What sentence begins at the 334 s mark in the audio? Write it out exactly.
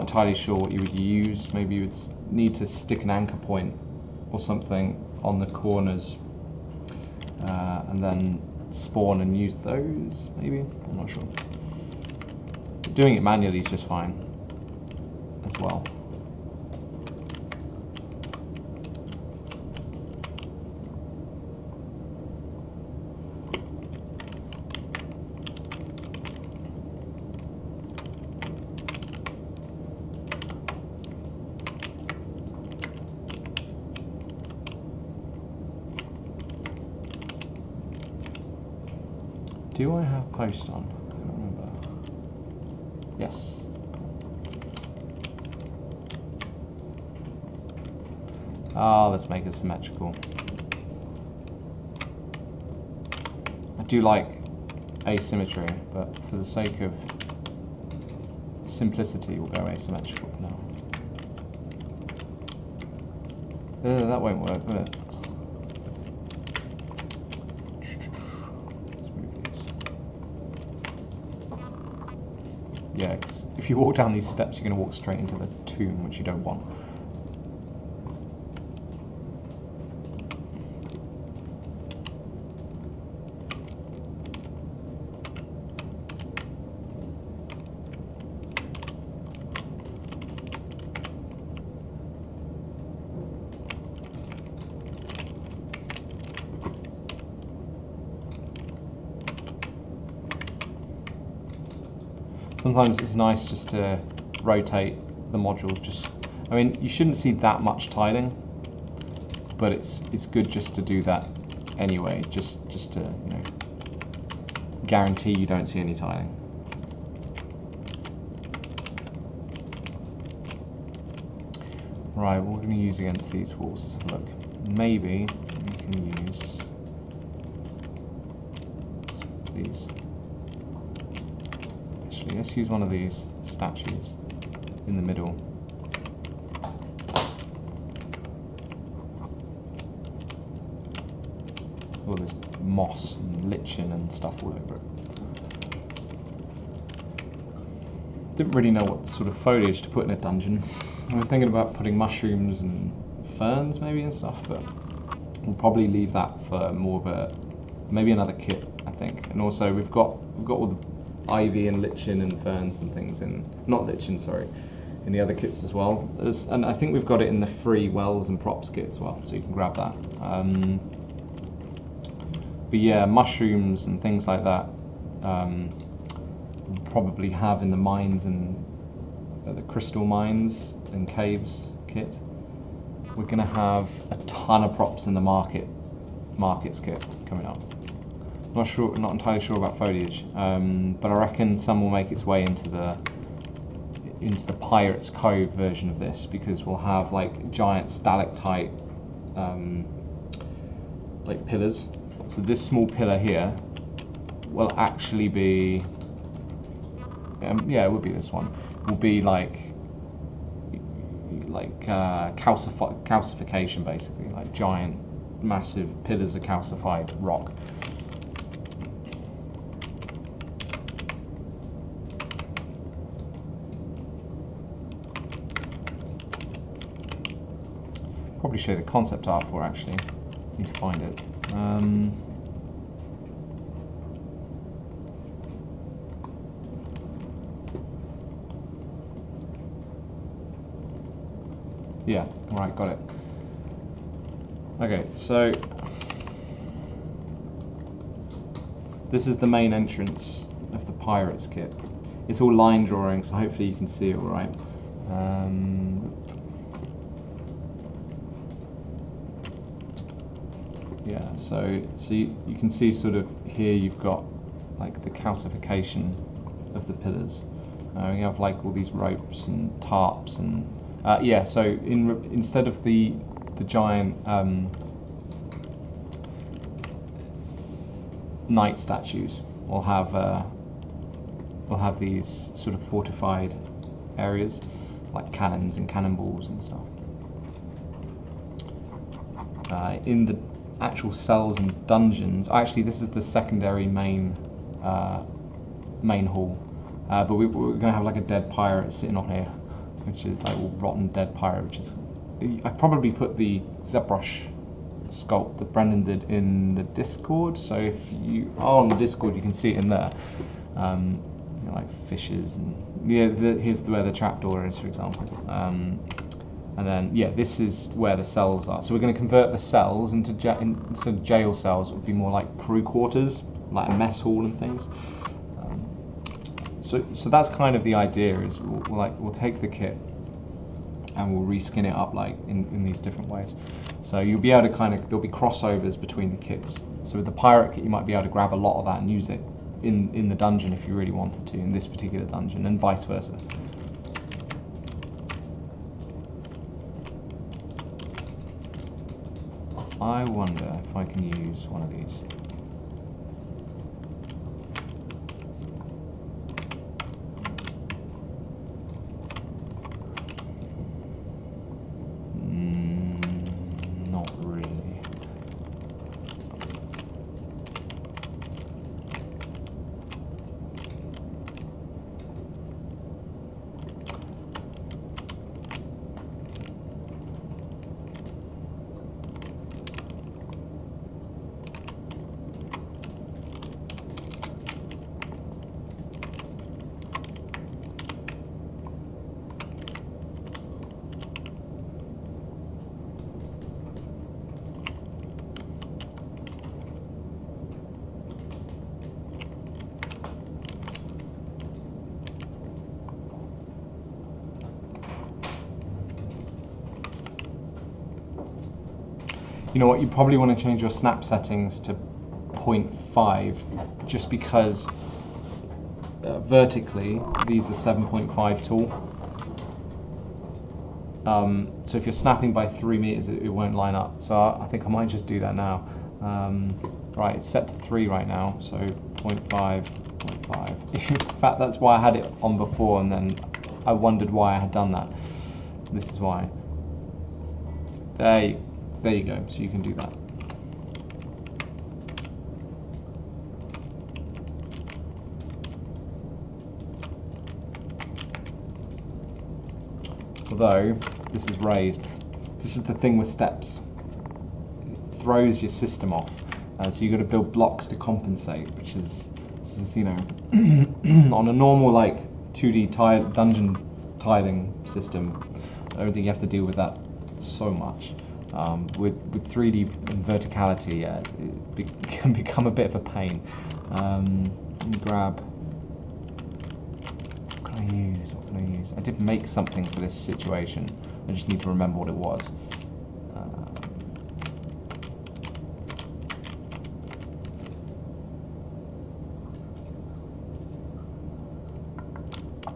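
So you'll be able to kind of, there'll be crossovers between the kits.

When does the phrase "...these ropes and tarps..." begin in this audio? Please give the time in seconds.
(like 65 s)
268 s.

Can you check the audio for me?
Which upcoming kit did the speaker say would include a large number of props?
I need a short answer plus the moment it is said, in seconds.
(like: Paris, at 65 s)
Markets kit, at 186 s.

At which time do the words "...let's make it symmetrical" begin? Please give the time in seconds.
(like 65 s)
49 s.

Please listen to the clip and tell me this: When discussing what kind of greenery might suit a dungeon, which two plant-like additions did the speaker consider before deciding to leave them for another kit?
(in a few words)
Mushrooms and ferns.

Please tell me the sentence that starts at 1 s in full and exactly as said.
Maybe you would need to stick an anchor point or something on the corners uh, and then spawn and use those, maybe?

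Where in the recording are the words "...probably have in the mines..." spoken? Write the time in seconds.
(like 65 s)
176 s.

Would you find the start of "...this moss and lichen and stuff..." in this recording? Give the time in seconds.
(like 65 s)
142 s.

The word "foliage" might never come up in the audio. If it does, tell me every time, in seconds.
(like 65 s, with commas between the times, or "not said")
149 s, 189 s.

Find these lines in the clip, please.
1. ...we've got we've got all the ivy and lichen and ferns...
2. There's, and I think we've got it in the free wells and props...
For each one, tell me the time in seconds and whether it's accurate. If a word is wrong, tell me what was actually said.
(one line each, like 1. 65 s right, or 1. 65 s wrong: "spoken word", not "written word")
1. 159 s right
2. 166 s right.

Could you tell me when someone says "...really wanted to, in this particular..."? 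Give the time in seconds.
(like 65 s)
340 s.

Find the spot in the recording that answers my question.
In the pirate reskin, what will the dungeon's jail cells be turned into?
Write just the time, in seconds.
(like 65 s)
322 s.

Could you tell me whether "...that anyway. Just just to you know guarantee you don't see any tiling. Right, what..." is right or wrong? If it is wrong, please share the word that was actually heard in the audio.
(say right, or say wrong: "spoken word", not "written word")
right.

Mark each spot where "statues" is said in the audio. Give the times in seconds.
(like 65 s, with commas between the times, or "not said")
133 s, 278 s.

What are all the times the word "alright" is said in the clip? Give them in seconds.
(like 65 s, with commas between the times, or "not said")
242 s, 254 s.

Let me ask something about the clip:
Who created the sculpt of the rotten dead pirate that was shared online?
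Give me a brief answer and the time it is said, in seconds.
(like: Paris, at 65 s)
Brendan, at 305 s.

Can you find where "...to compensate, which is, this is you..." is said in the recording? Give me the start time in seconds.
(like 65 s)
457 s.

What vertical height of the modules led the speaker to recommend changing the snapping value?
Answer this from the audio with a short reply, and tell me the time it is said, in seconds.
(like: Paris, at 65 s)
7.5, at 417 s.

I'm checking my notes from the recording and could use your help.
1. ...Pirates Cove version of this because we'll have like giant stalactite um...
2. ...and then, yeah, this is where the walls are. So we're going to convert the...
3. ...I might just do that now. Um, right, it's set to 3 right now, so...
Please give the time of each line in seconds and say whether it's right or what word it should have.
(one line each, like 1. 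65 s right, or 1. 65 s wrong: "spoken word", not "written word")
1. 194 s right
2. 316 s wrong: "cells", not "walls"
3. 424 s right.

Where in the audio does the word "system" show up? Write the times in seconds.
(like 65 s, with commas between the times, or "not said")
455 s, 464 s.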